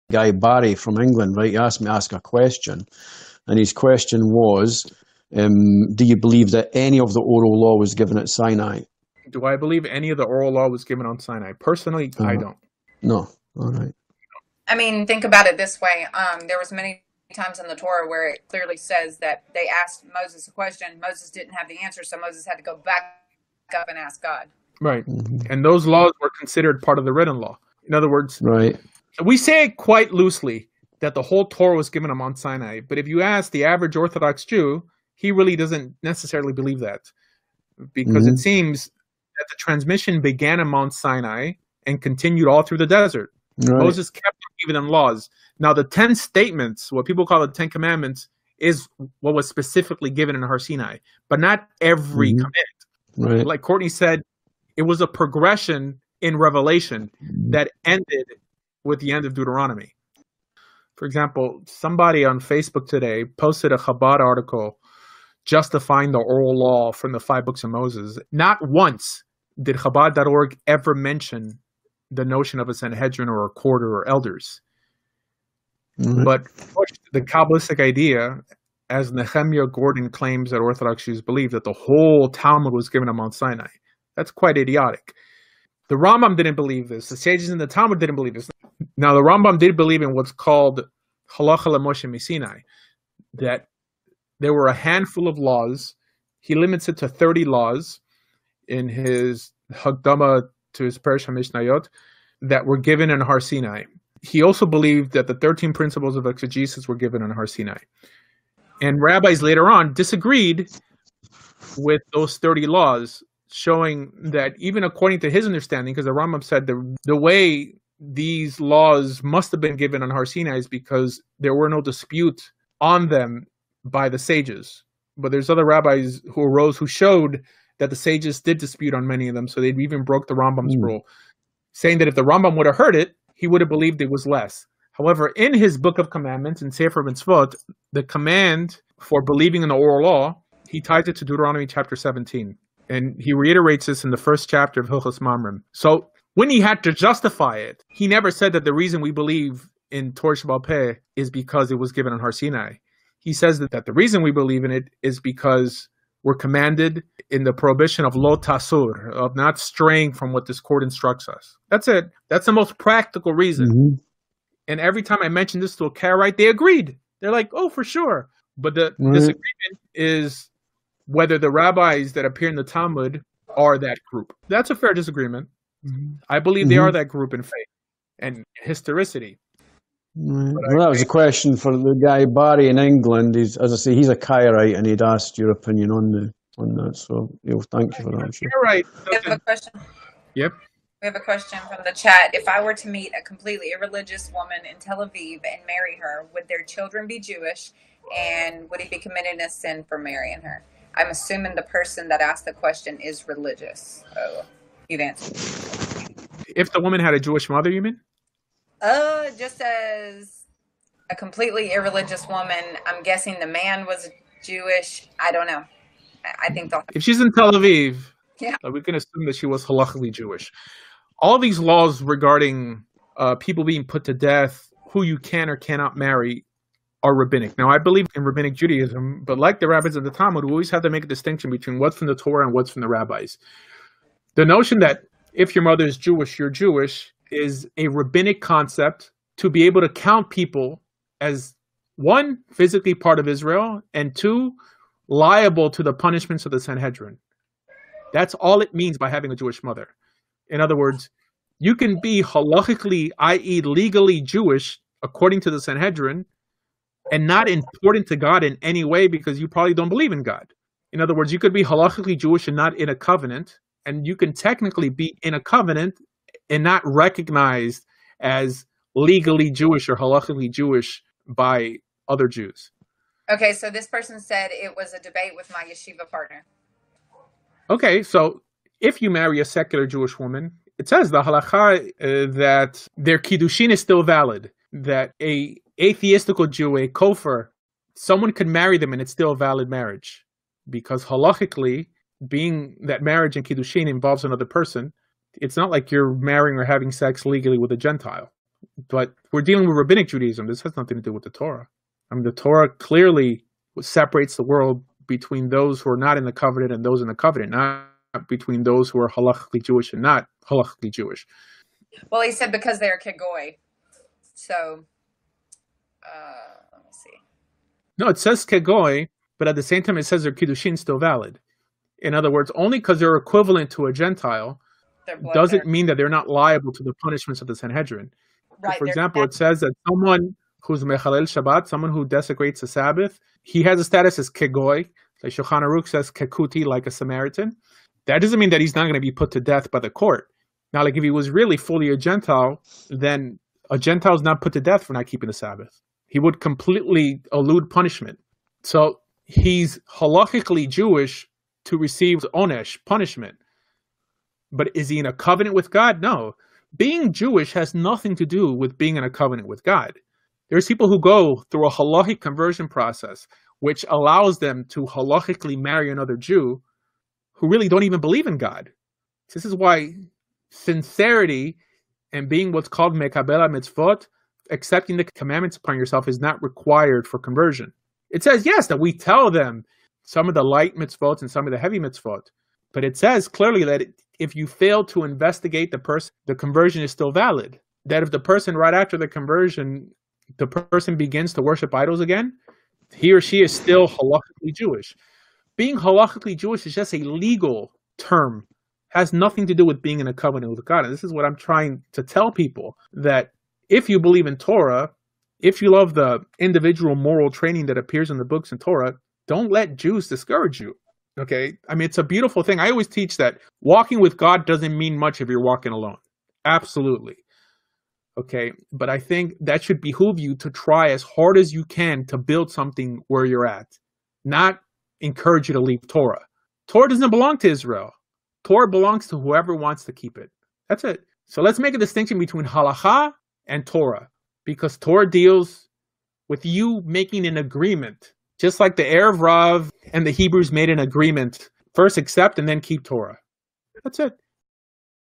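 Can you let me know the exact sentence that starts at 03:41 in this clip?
All these laws regarding uh, people being put to death, who you can or cannot marry, are rabbinic.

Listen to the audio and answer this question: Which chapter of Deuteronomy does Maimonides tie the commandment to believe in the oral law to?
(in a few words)
Chapter 17.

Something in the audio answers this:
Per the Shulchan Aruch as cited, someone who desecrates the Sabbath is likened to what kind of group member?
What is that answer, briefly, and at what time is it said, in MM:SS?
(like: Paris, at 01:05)
Samaritan, at 05:36.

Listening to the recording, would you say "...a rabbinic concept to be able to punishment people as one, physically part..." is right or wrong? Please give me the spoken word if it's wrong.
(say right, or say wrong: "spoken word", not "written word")
wrong: "count", not "punishment".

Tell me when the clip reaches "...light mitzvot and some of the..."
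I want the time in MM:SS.
06:20.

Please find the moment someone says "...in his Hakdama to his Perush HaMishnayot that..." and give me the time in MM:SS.
01:38.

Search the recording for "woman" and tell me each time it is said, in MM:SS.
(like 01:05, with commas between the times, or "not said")
03:14, 03:26, 03:32, 04:40.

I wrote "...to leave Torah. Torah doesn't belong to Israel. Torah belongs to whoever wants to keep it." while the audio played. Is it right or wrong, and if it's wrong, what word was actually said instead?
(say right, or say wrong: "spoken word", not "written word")
right.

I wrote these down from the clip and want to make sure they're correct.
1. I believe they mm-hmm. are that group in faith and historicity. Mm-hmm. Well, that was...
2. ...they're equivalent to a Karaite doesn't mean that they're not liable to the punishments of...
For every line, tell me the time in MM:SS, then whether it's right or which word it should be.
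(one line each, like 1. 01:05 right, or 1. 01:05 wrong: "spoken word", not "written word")
1. 02:56 right
2. 05:22 wrong: "Gentile", not "Karaite".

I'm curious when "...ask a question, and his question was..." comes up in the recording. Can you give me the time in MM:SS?
00:01.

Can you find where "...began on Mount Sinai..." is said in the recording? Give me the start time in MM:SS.
00:40.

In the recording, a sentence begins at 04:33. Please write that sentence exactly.
Okay, so this person said it was a debate with my yeshiva partner.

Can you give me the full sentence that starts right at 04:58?
But we're dealing with rabbinic Judaism.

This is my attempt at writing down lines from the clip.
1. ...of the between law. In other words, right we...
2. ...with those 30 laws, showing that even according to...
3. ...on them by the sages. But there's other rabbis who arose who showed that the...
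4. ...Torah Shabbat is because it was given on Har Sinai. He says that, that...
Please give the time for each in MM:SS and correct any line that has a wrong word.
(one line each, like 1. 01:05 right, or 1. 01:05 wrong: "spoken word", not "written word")
1. 00:26 wrong: "written", not "between"
2. 01:51 right
3. 02:02 right
4. 02:30 right.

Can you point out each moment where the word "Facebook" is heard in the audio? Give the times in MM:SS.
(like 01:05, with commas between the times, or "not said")
01:02.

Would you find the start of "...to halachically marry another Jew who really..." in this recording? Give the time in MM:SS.
06:04.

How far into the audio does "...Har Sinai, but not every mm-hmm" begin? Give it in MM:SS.
00:50.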